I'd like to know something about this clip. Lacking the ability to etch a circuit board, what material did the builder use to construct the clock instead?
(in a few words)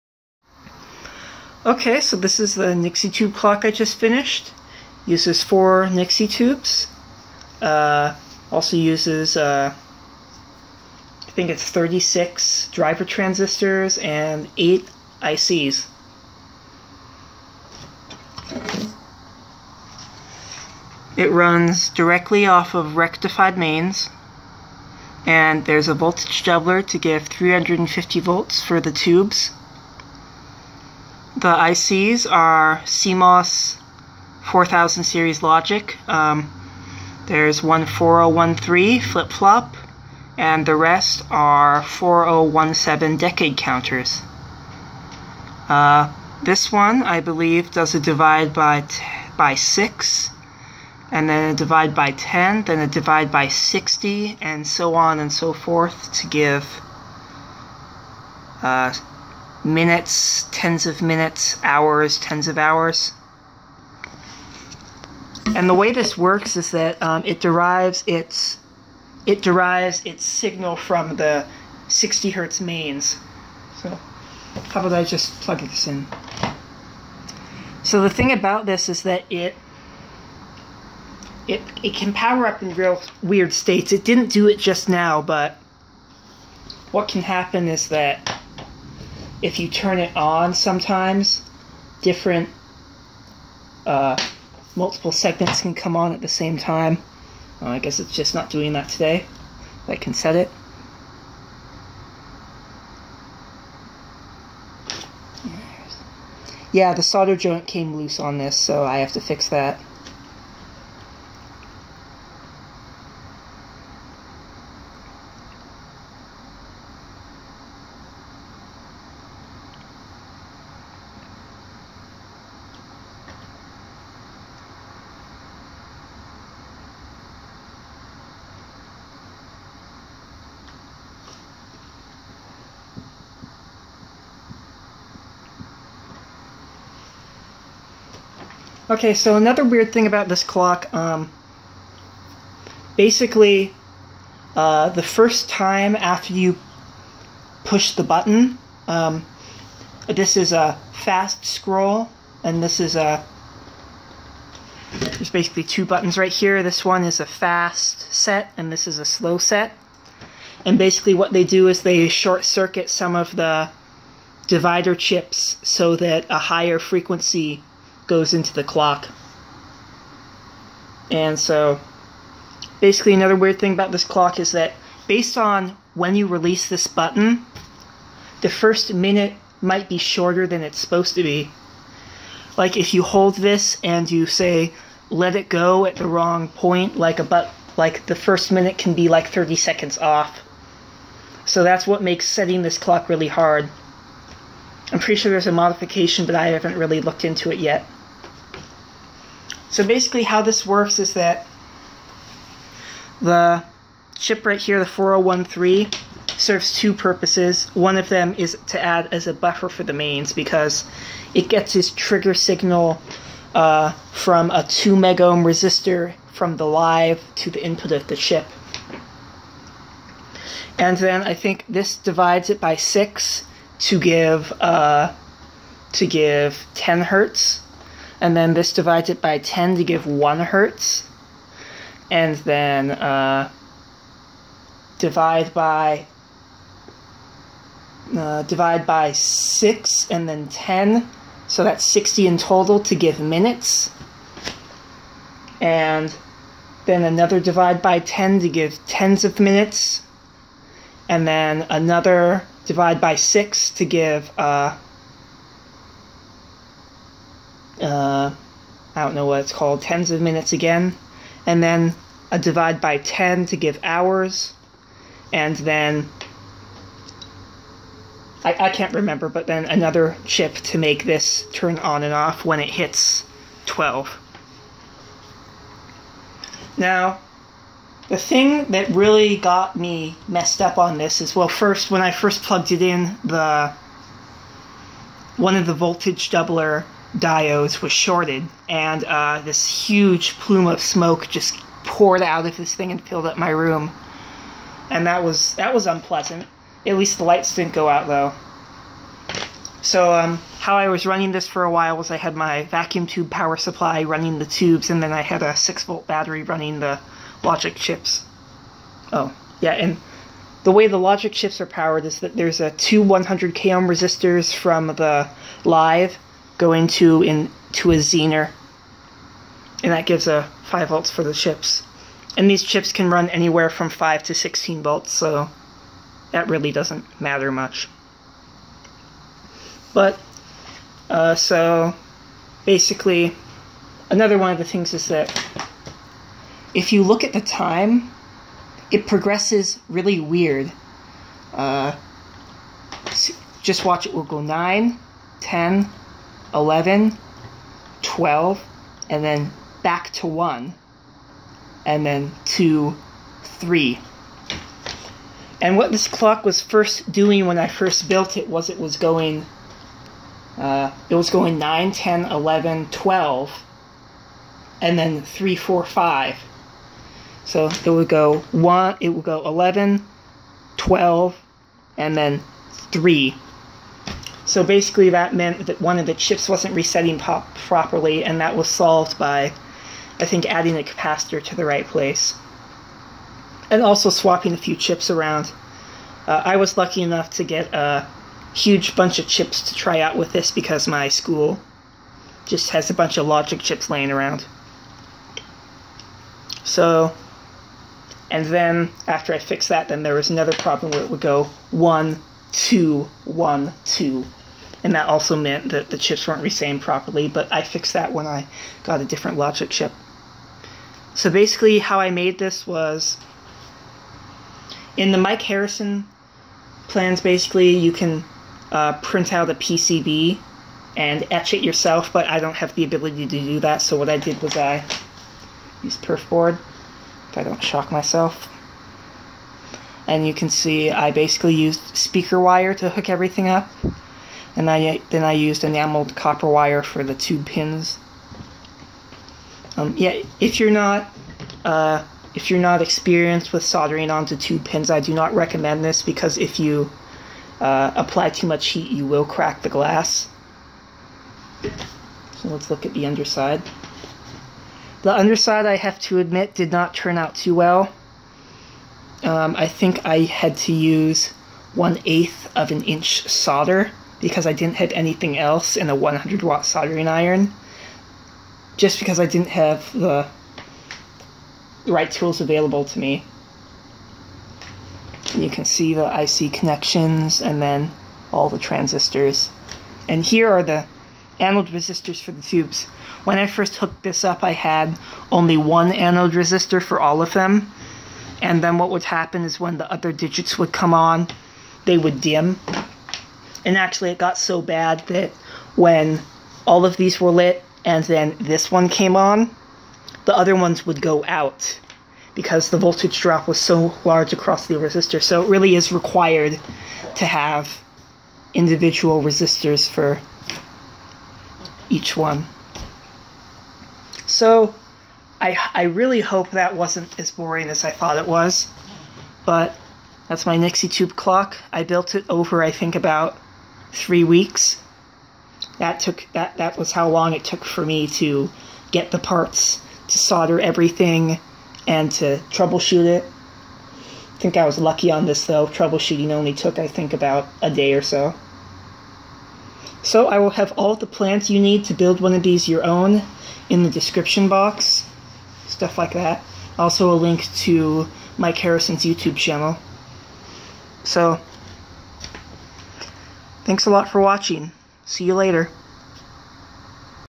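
perf board.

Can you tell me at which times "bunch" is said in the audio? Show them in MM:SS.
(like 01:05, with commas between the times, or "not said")
06:28, 06:32.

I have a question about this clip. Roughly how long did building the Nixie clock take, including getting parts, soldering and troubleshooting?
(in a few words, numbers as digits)
3 weeks.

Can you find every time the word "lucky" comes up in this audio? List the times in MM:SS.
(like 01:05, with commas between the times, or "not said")
06:26, 08:54.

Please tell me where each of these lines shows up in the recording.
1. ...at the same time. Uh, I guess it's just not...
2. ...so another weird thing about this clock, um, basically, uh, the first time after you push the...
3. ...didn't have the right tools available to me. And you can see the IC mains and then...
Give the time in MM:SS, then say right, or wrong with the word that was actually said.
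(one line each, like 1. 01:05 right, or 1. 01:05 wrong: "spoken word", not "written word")
1. 01:36 right
2. 02:19 right
3. 07:49 wrong: "connections", not "mains".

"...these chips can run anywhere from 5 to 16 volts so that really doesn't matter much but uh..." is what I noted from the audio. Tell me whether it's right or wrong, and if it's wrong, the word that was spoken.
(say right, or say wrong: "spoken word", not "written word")
right.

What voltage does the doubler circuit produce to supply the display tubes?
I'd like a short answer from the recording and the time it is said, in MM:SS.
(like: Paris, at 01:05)
350 volts, at 00:27.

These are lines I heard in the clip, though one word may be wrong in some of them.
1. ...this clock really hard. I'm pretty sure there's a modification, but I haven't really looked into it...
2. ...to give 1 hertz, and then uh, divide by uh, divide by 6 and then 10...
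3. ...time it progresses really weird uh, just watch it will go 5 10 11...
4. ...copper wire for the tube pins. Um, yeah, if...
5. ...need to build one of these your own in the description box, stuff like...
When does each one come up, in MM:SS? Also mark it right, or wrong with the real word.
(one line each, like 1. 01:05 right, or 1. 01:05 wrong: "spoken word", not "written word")
1. 03:12 right
2. 03:49 right
3. 05:37 wrong: "9", not "5"
4. 07:16 right
5. 09:01 right.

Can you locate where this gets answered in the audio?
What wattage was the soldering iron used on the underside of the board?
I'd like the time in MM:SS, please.
07:45.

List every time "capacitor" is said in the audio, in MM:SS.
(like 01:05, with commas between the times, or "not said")
06:20.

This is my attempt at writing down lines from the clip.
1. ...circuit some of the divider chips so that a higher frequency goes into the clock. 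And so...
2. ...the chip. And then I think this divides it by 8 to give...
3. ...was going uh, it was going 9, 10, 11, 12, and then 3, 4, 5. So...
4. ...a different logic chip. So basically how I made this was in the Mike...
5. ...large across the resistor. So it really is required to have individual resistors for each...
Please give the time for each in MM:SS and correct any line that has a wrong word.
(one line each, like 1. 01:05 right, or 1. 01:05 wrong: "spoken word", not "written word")
1. 02:42 right
2. 03:38 wrong: "6", not "8"
3. 05:58 right
4. 06:49 right
5. 08:24 right.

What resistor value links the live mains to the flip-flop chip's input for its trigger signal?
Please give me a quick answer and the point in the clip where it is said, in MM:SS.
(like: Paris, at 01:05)
2 megohm, at 03:34.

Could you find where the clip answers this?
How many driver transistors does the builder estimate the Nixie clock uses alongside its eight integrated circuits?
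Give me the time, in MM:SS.
00:11.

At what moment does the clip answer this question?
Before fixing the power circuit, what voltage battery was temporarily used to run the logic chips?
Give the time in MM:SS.
05:05.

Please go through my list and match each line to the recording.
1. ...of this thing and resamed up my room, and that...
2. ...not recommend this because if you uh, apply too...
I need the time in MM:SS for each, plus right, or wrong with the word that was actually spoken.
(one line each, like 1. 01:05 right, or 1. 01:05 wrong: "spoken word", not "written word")
1. 04:52 wrong: "filled", not "resamed"
2. 07:25 right.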